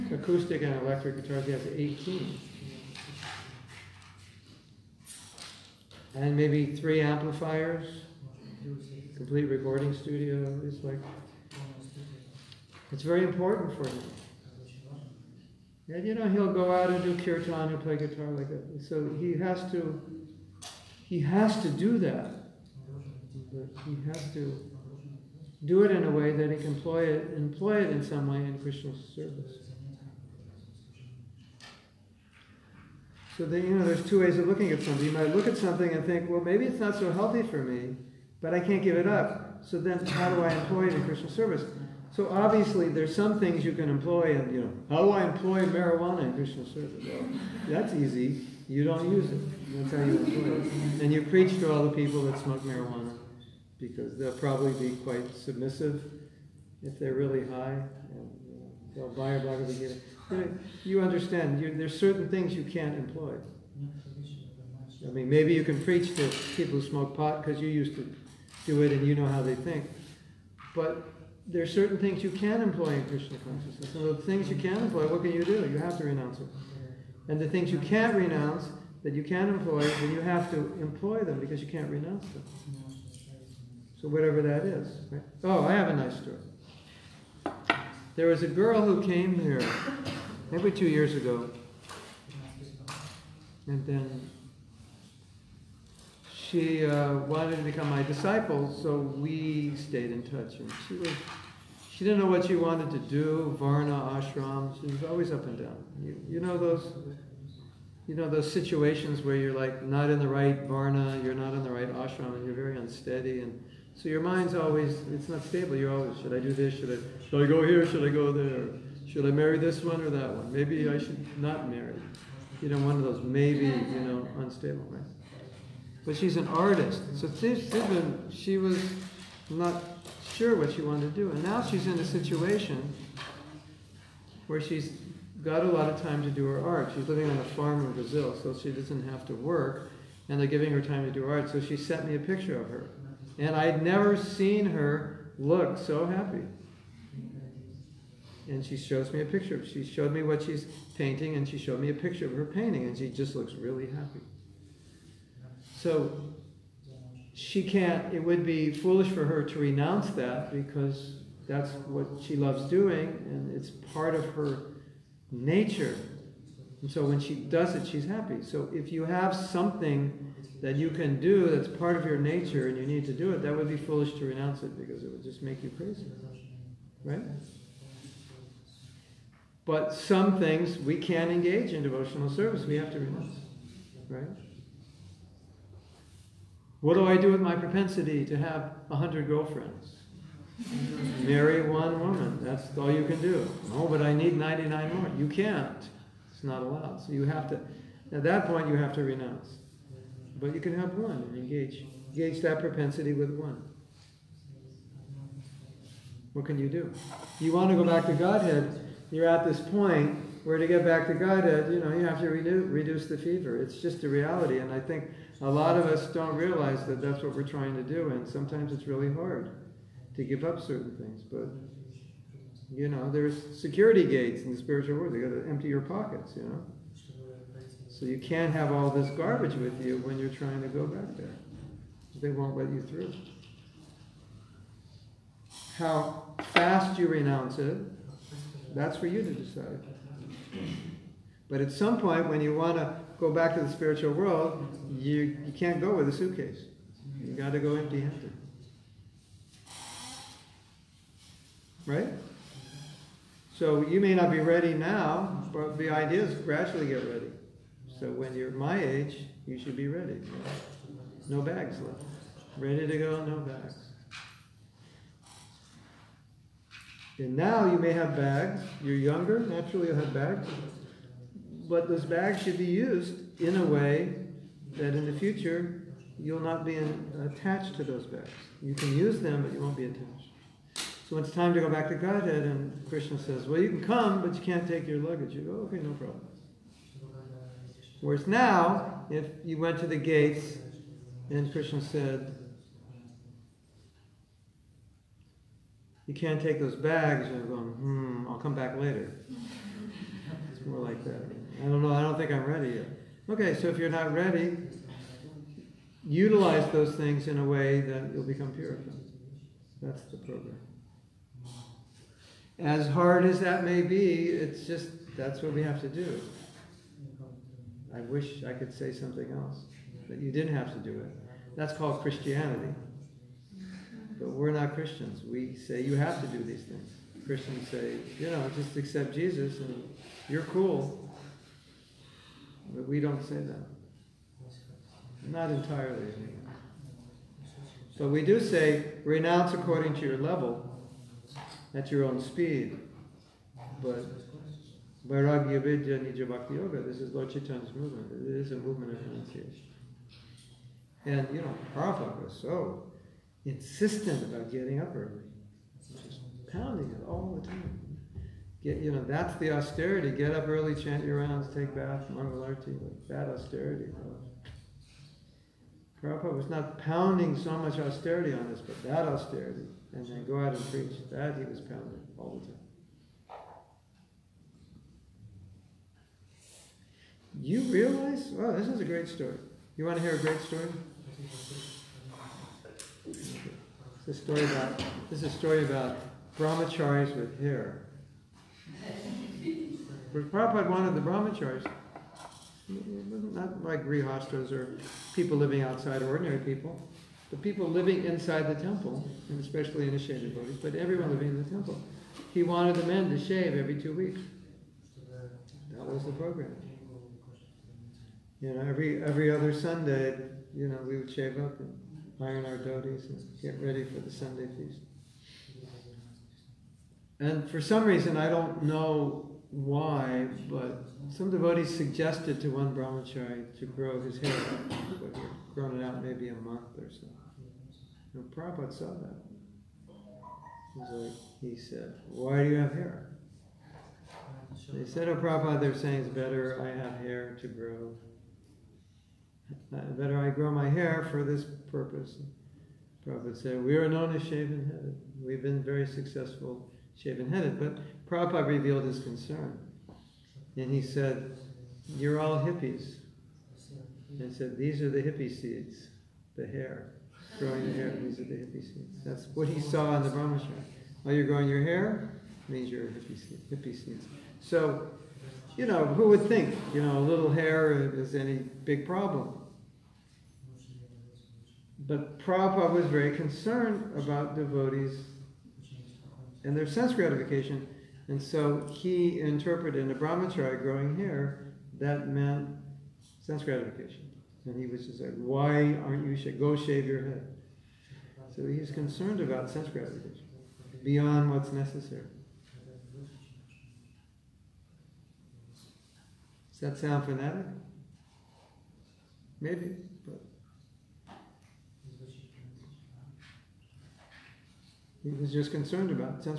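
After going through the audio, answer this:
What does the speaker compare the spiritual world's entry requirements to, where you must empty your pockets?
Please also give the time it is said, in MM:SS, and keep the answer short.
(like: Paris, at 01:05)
Security gates, at 03:43.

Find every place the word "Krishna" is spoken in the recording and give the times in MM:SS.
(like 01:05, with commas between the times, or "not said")
00:28, 00:41, 00:46, 01:13, 04:42, 04:51.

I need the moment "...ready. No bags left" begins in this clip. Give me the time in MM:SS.
04:19.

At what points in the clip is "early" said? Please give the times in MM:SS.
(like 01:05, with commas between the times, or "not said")
05:54, 06:00.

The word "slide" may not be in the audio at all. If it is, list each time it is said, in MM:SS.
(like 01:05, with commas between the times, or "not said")
not said.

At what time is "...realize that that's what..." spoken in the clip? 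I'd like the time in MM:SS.
03:36.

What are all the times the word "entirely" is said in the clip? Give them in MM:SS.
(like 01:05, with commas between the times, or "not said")
05:35.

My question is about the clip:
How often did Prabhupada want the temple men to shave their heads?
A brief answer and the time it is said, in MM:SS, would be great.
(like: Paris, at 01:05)
Every two weeks, at 06:43.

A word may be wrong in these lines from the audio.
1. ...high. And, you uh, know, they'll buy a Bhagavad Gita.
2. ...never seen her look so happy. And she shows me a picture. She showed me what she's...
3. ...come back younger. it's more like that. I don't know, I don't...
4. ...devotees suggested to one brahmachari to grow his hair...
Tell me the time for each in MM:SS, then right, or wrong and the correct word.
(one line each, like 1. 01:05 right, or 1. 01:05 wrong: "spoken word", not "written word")
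1. 00:57 right
2. 02:23 right
3. 04:58 wrong: "later", not "younger"
4. 07:01 right.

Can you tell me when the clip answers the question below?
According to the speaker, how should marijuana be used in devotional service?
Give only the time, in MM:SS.
00:48.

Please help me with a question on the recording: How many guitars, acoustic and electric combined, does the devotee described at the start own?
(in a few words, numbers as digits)
18.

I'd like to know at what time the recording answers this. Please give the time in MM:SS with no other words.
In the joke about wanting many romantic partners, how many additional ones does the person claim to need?
03:14.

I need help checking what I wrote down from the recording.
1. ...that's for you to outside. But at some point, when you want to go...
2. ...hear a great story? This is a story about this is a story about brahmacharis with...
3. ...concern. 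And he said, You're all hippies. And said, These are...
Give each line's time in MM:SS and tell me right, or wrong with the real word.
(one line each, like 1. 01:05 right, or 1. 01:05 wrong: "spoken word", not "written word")
1. 03:58 wrong: "decide", not "outside"
2. 06:20 right
3. 07:28 right.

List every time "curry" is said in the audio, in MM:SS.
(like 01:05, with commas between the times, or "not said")
not said.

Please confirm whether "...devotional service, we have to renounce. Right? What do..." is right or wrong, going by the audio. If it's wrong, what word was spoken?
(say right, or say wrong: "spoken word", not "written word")
right.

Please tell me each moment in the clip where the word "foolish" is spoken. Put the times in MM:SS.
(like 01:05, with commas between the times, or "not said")
02:38, 02:53.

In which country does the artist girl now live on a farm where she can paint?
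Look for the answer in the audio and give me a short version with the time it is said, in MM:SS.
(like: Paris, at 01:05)
Brazil, at 02:17.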